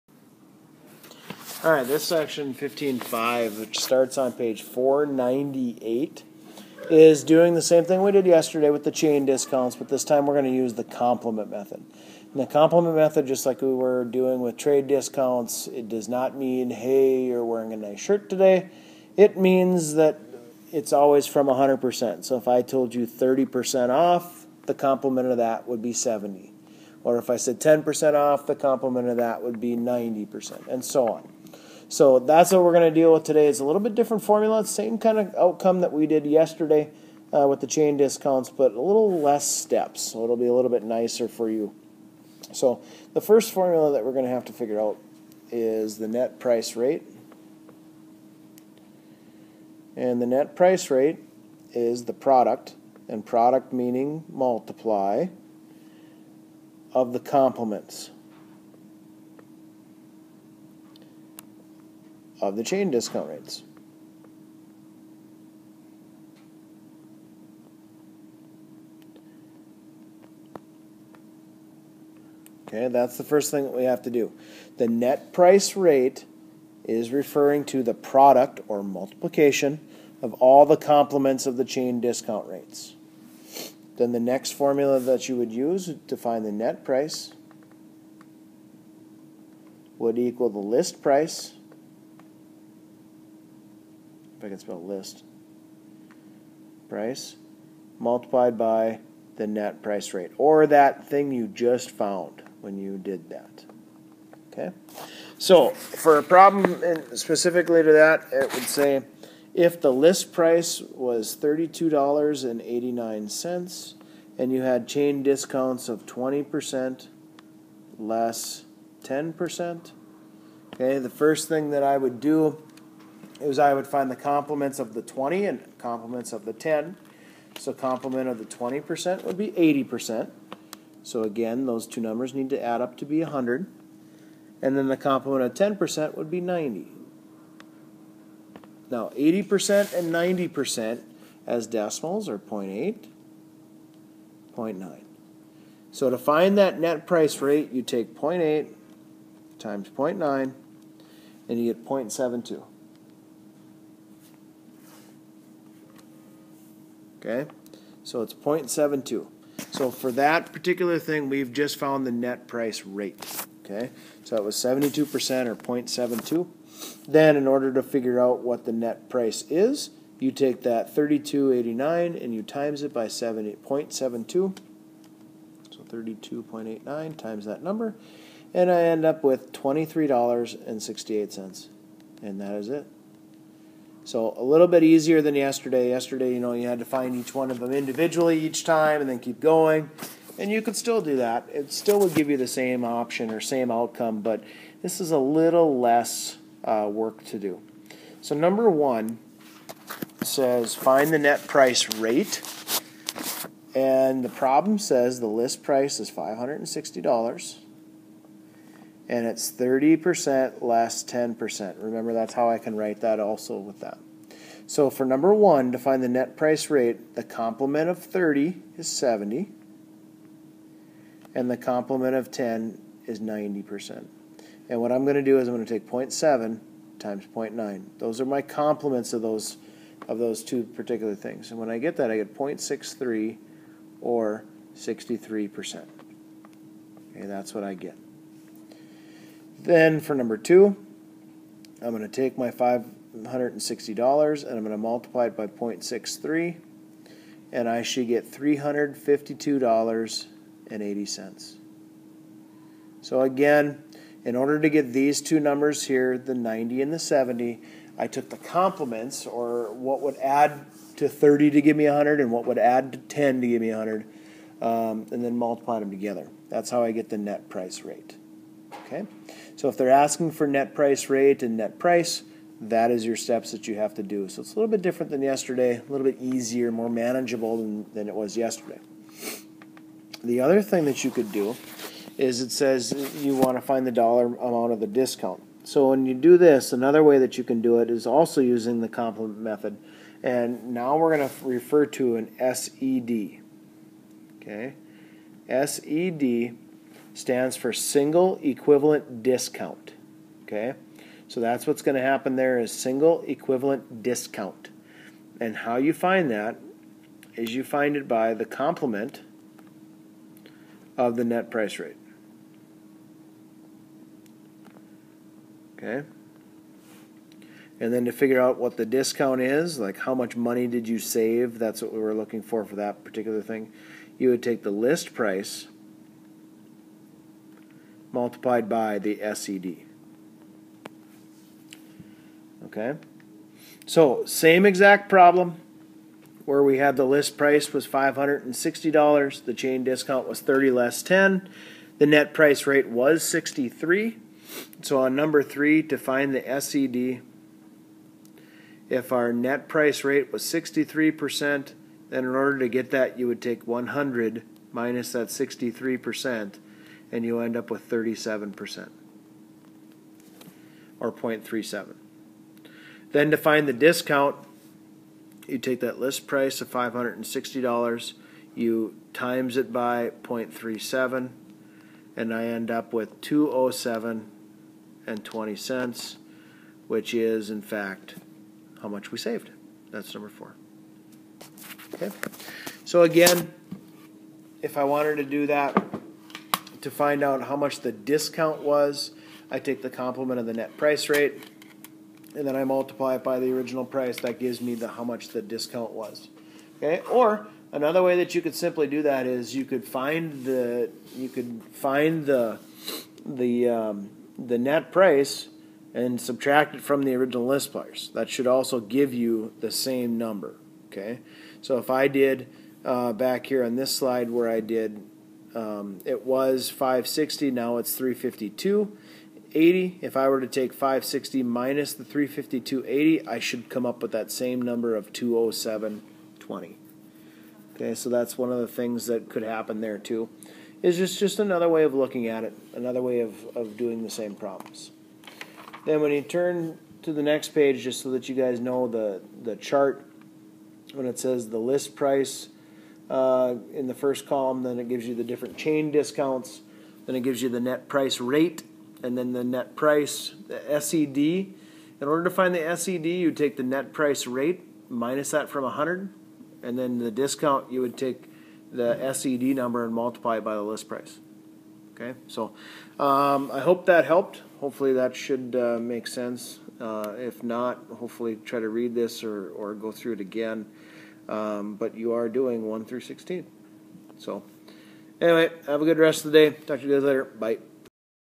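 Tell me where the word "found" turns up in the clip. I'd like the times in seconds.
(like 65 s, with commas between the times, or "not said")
101 s, 161 s.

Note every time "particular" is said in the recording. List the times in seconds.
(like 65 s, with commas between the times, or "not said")
160 s, 230 s, 323 s.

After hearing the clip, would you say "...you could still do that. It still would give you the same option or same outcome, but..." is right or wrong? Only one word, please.
right.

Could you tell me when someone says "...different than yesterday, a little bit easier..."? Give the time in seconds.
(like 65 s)
274 s.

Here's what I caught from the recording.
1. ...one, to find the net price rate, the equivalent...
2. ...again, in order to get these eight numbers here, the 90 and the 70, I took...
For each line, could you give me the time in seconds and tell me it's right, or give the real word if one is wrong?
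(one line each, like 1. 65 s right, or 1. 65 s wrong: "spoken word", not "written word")
1. 215 s wrong: "complement", not "equivalent"
2. 253 s wrong: "two", not "eight".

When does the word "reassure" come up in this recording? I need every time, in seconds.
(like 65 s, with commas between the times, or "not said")
not said.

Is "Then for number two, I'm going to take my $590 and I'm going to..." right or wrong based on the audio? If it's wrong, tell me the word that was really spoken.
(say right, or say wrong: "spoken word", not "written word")
wrong: "560", not "590".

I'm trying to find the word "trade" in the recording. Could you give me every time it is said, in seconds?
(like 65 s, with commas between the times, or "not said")
14 s.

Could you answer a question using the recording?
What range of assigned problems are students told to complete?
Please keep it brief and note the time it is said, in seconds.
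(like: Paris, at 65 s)
1 through 16, at 472 s.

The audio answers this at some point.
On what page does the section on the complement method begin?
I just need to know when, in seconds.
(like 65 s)
4 s.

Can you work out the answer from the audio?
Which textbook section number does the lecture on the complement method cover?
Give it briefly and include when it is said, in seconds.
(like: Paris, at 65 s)
15.5, at 2 s.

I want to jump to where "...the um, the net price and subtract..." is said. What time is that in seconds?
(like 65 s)
403 s.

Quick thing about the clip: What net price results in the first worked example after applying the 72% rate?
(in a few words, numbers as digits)
$23.68.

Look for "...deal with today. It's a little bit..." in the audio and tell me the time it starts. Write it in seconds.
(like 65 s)
33 s.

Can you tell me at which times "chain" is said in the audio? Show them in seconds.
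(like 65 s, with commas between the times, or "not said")
8 s, 37 s, 62 s, 81 s, 114 s, 339 s, 445 s.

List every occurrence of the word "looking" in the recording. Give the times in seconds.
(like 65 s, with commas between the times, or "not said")
322 s, 431 s.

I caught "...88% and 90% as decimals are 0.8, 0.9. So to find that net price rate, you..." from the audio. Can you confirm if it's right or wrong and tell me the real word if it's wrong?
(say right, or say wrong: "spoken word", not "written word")
wrong: "80", not "88".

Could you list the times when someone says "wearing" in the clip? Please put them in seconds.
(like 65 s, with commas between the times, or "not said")
17 s.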